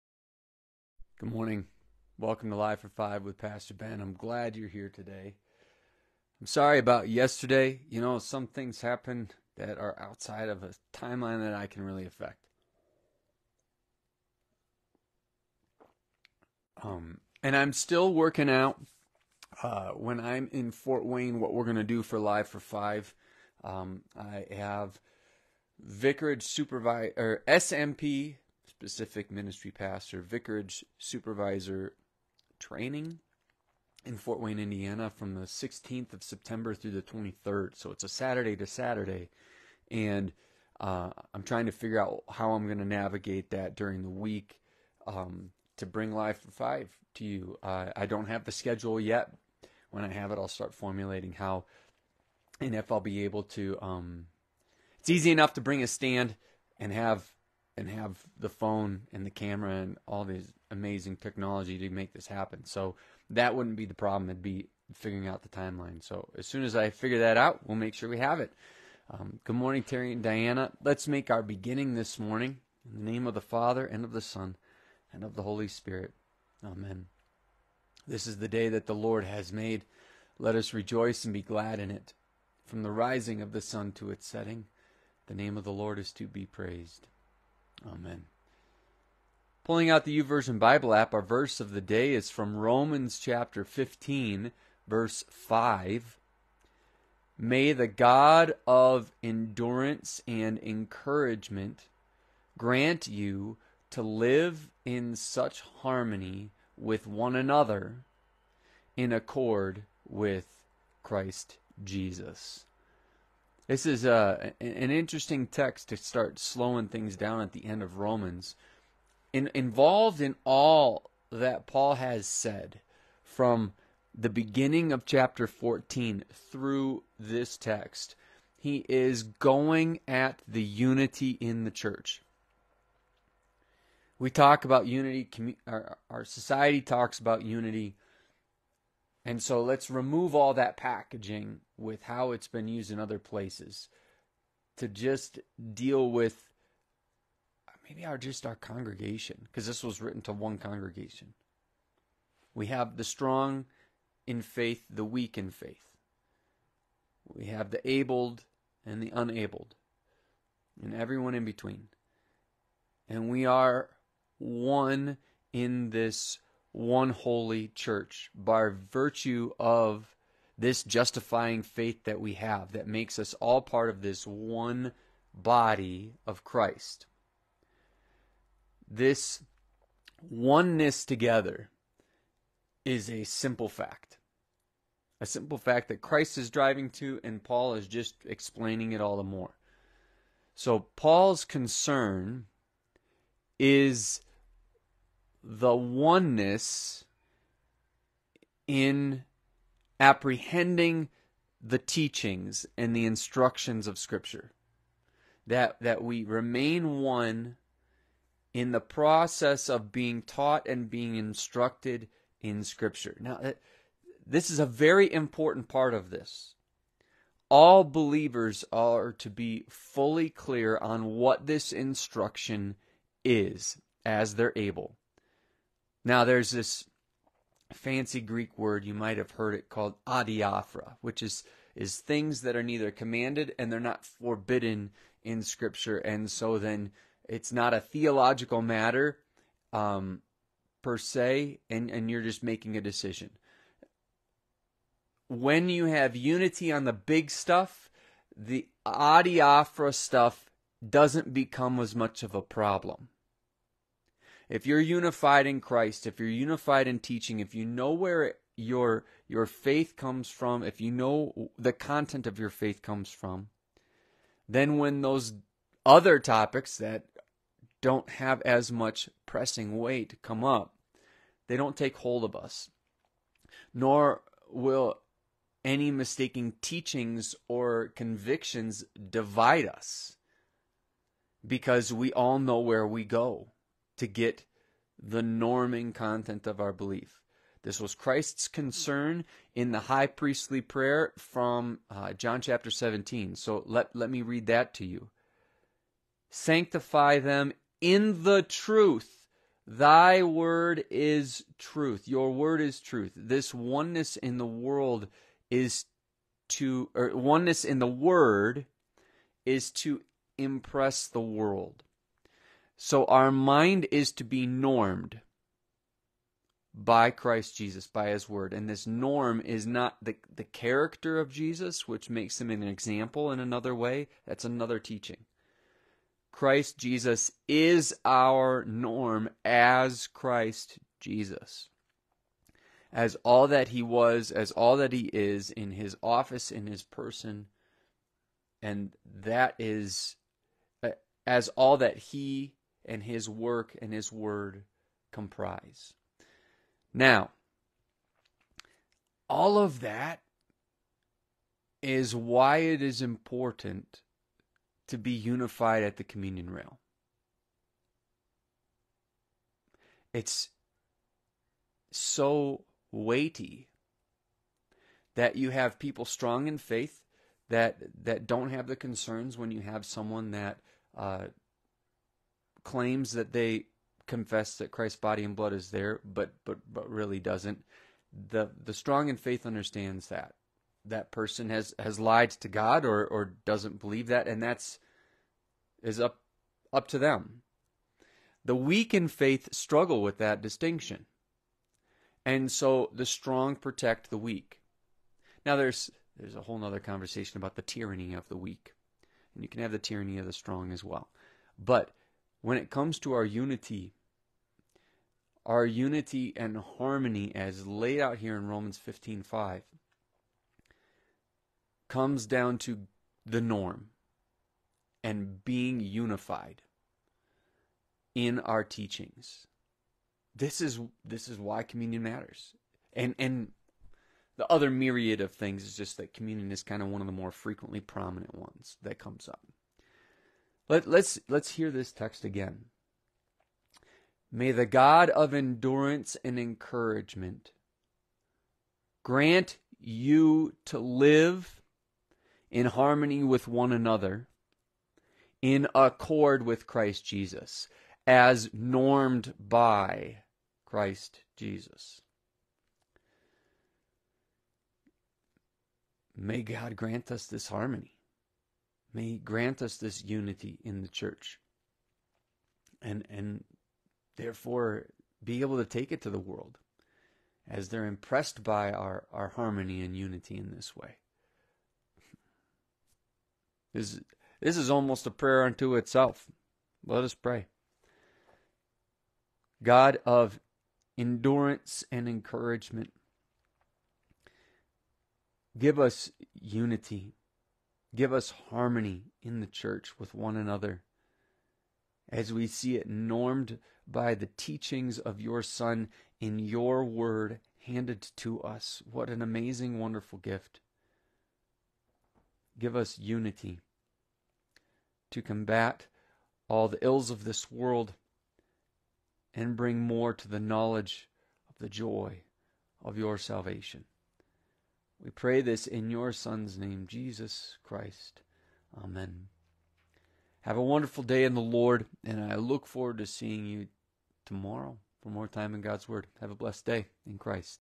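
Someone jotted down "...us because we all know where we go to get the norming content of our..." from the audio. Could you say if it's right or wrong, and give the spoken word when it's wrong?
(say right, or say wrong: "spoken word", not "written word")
right.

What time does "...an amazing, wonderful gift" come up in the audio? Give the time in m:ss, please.
8:19.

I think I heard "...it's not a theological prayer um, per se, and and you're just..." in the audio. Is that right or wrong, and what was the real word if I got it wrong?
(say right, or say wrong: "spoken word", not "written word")
wrong: "matter", not "prayer".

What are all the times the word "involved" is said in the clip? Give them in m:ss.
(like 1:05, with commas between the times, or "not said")
1:59.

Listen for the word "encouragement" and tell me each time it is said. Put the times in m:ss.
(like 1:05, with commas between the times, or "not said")
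1:40, 7:16, 8:02.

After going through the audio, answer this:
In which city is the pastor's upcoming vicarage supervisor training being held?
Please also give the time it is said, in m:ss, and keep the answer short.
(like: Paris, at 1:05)
Fort Wayne, Indiana, at 0:34.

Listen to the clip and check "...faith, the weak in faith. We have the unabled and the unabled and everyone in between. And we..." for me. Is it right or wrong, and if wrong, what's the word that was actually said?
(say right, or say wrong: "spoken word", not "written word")
wrong: "abled", not "unabled".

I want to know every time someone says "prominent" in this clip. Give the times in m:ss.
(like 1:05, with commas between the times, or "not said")
7:07.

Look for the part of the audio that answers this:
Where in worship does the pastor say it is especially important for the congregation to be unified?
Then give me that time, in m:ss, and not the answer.
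5:56.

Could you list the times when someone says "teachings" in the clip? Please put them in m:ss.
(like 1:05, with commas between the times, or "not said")
3:21, 4:16, 4:36, 5:24, 6:58, 8:14.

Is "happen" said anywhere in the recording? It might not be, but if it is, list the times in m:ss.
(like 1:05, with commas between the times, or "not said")
0:08, 1:02.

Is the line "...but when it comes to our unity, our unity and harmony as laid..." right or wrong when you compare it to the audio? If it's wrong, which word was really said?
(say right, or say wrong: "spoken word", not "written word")
right.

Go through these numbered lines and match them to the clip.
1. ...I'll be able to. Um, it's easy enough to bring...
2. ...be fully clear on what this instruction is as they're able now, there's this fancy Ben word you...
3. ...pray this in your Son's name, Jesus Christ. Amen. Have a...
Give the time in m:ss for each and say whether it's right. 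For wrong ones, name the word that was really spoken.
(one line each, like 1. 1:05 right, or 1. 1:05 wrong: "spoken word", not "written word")
1. 0:52 right
2. 3:39 wrong: "Greek", not "Ben"
3. 8:35 right.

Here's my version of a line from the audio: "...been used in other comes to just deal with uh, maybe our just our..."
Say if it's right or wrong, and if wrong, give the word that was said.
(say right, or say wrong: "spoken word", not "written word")
wrong: "places", not "comes".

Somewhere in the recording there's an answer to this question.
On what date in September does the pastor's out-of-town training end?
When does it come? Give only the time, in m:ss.
0:36.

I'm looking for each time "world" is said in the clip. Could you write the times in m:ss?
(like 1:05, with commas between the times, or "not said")
5:04, 5:11, 7:46, 8:27.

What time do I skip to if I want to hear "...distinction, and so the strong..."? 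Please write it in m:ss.
6:30.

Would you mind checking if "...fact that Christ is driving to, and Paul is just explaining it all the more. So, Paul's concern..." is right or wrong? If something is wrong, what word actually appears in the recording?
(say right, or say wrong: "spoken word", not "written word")
right.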